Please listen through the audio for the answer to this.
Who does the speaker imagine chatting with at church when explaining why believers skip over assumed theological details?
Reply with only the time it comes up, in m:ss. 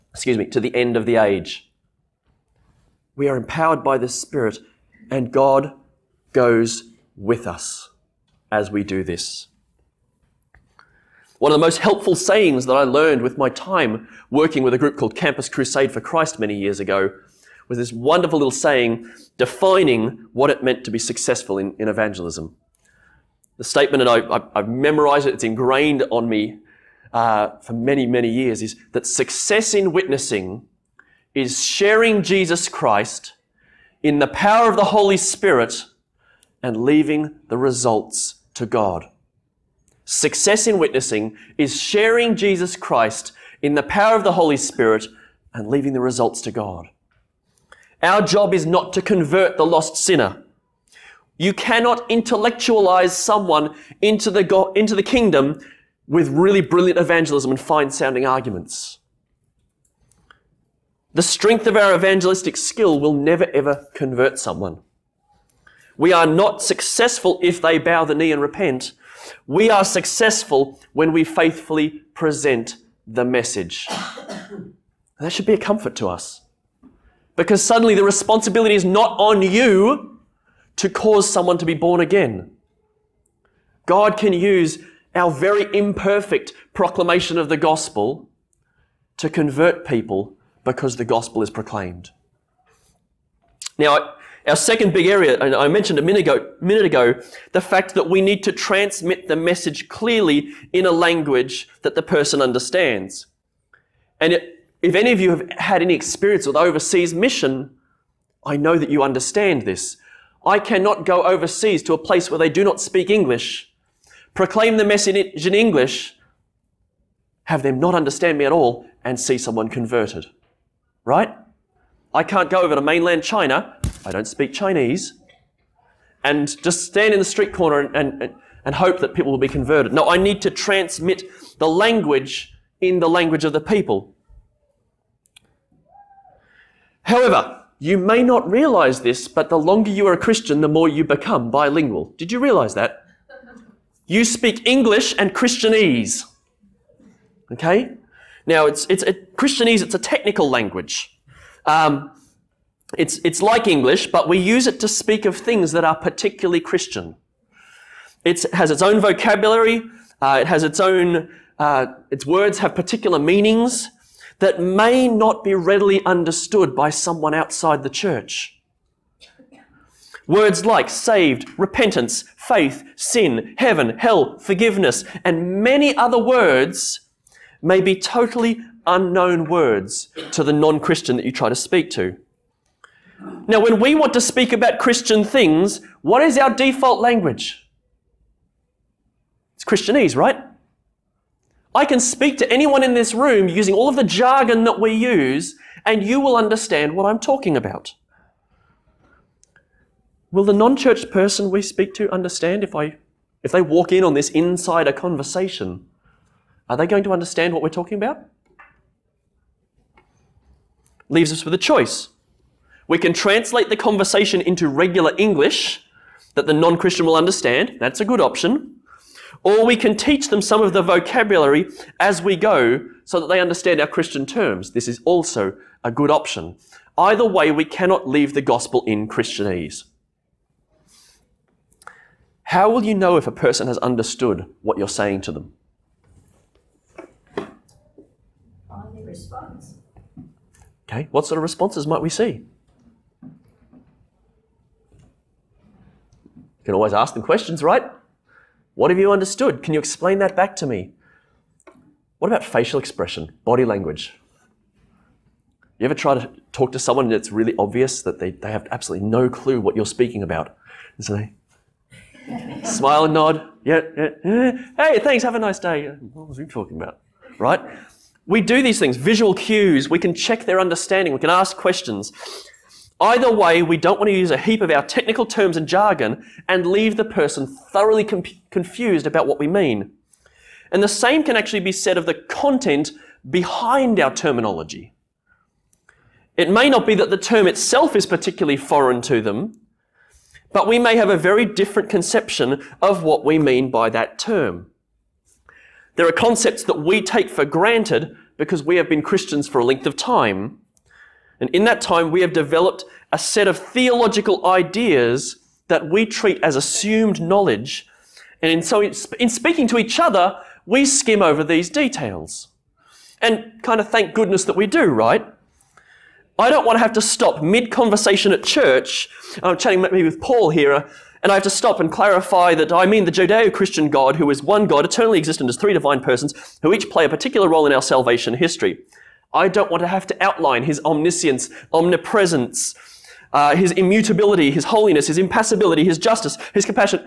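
5:20.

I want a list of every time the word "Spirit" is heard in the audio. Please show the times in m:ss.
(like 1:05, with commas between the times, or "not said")
0:04, 0:35, 0:44.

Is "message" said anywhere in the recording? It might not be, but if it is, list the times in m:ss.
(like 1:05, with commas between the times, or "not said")
1:13, 1:39, 1:54.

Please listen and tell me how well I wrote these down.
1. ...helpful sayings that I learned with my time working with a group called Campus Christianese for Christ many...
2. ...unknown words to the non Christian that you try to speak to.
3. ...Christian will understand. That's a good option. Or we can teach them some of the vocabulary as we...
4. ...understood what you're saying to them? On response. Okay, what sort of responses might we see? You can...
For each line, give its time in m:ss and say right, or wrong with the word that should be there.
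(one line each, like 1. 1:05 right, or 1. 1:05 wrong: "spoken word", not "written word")
1. 0:11 wrong: "Crusade", not "Christianese"
2. 2:58 right
3. 3:36 right
4. 3:53 right.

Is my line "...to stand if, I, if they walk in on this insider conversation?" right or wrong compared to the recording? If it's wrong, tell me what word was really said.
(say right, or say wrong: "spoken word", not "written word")
wrong: "understand", not "stand".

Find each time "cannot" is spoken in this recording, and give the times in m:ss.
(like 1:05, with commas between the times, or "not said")
0:51, 1:50, 3:47.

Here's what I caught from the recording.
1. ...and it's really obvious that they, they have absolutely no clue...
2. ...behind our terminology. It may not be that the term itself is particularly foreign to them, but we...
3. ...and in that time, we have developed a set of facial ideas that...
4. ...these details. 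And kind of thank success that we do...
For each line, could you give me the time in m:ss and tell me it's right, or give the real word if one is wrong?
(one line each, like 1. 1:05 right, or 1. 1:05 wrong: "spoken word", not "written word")
1. 4:17 right
2. 4:43 right
3. 5:01 wrong: "theological", not "facial"
4. 5:11 wrong: "goodness", not "success".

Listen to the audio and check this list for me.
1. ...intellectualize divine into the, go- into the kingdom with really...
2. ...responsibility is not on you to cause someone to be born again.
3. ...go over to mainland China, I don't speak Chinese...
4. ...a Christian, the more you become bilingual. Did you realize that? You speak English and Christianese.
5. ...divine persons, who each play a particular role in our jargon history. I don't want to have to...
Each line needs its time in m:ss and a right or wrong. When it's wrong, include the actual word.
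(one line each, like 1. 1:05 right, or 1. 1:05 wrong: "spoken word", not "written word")
1. 0:52 wrong: "someone", not "divine"
2. 1:18 right
3. 2:02 right
4. 2:20 right
5. 5:25 wrong: "salvation", not "jargon".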